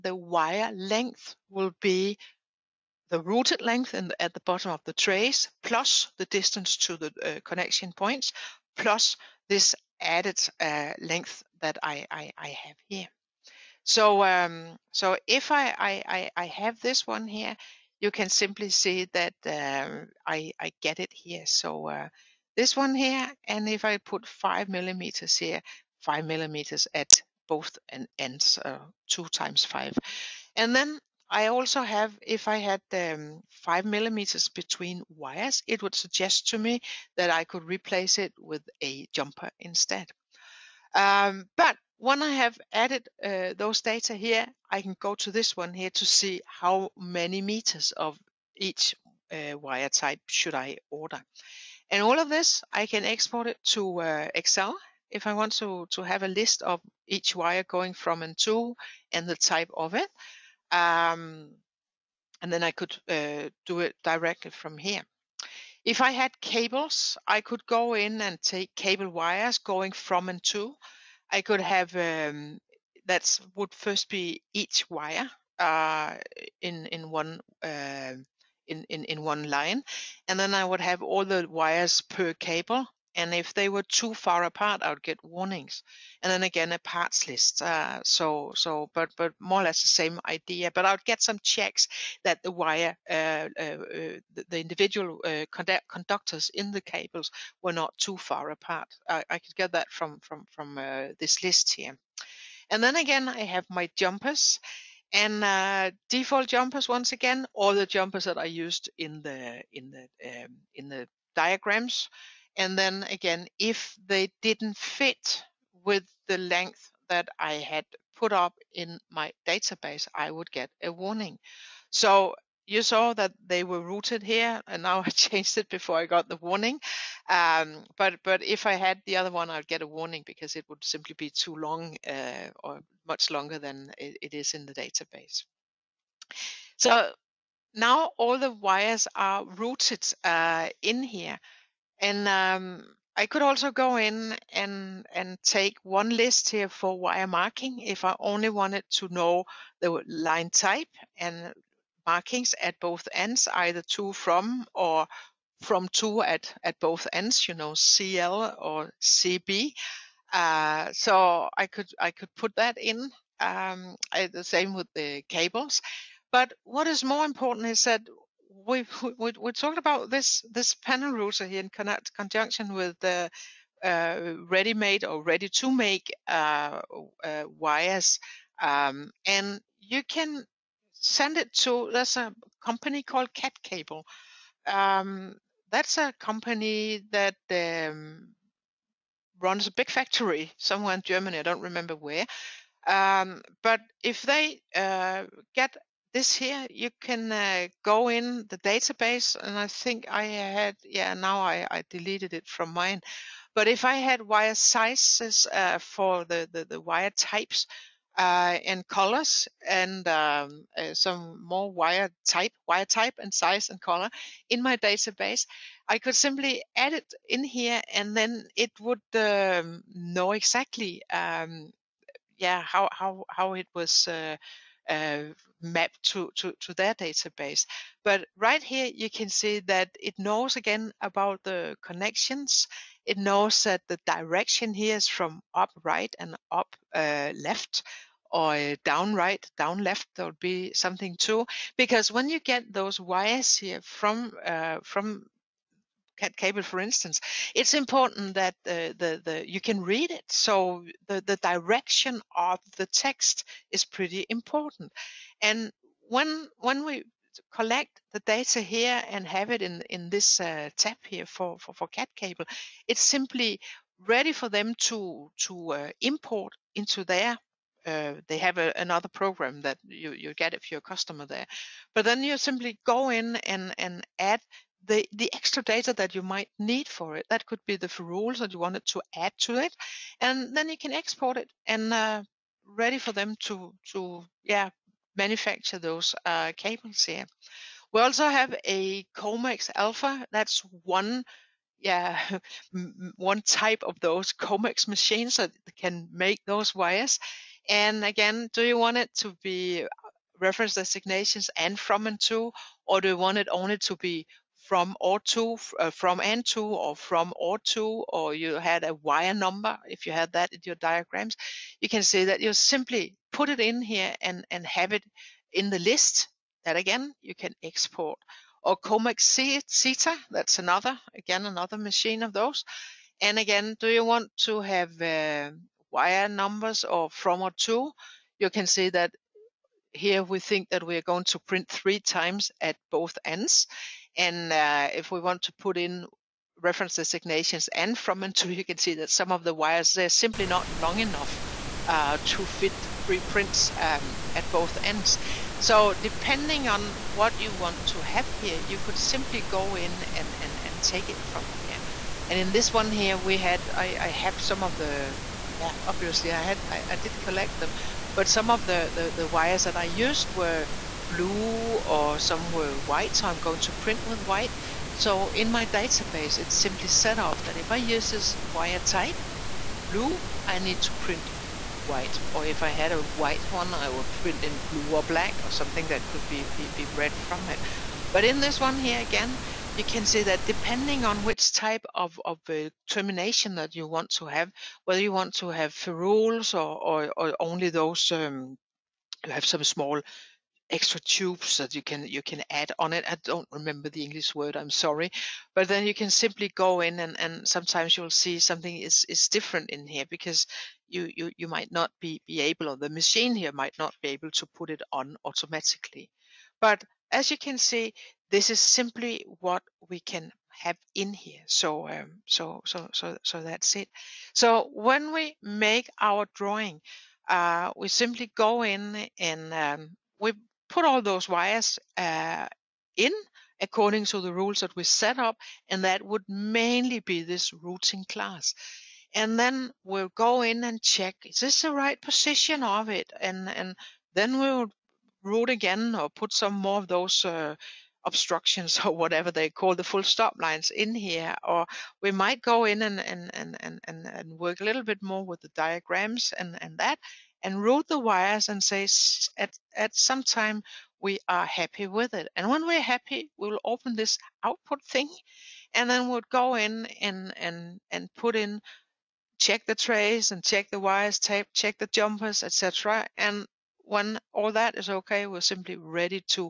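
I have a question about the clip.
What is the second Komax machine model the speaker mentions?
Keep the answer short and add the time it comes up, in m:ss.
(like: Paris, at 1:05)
Komax Zeta, at 5:18.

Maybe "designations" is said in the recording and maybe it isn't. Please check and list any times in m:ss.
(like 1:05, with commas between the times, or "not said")
5:00, 5:36.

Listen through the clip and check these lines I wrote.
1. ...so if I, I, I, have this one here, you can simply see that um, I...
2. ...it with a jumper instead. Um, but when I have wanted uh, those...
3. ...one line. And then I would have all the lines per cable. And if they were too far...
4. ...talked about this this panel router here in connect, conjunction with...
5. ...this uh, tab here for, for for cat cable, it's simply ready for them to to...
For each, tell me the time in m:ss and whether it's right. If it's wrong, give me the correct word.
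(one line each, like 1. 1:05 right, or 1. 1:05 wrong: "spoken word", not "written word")
1. 0:14 right
2. 0:38 wrong: "added", not "wanted"
3. 1:19 wrong: "wires", not "lines"
4. 2:49 right
5. 4:20 right.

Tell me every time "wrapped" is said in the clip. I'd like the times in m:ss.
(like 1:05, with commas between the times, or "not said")
not said.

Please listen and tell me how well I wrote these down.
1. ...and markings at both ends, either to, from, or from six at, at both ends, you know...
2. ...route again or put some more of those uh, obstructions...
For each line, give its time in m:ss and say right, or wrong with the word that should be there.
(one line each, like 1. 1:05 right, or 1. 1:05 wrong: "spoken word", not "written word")
1. 2:31 wrong: "two", not "six"
2. 7:15 right.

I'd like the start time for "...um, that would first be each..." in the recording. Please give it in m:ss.
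1:11.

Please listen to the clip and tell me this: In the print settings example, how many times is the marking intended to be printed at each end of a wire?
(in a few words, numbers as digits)
3.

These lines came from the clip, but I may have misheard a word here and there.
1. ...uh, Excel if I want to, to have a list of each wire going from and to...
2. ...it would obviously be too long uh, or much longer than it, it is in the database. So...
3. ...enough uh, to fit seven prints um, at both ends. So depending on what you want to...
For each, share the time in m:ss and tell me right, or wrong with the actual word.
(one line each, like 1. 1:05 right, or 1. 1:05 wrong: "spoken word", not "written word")
1. 0:54 right
2. 2:10 wrong: "simply", not "obviously"
3. 5:40 wrong: "three", not "seven".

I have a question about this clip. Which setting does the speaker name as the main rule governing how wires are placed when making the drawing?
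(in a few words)
Routing class.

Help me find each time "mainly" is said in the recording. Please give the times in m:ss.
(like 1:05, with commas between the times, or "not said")
7:06.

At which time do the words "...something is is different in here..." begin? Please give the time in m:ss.
6:38.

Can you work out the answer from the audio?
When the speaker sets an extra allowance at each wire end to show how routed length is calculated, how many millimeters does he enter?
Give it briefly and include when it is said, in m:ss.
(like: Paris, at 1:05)
5, at 0:26.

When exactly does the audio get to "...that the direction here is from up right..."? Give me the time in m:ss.
3:53.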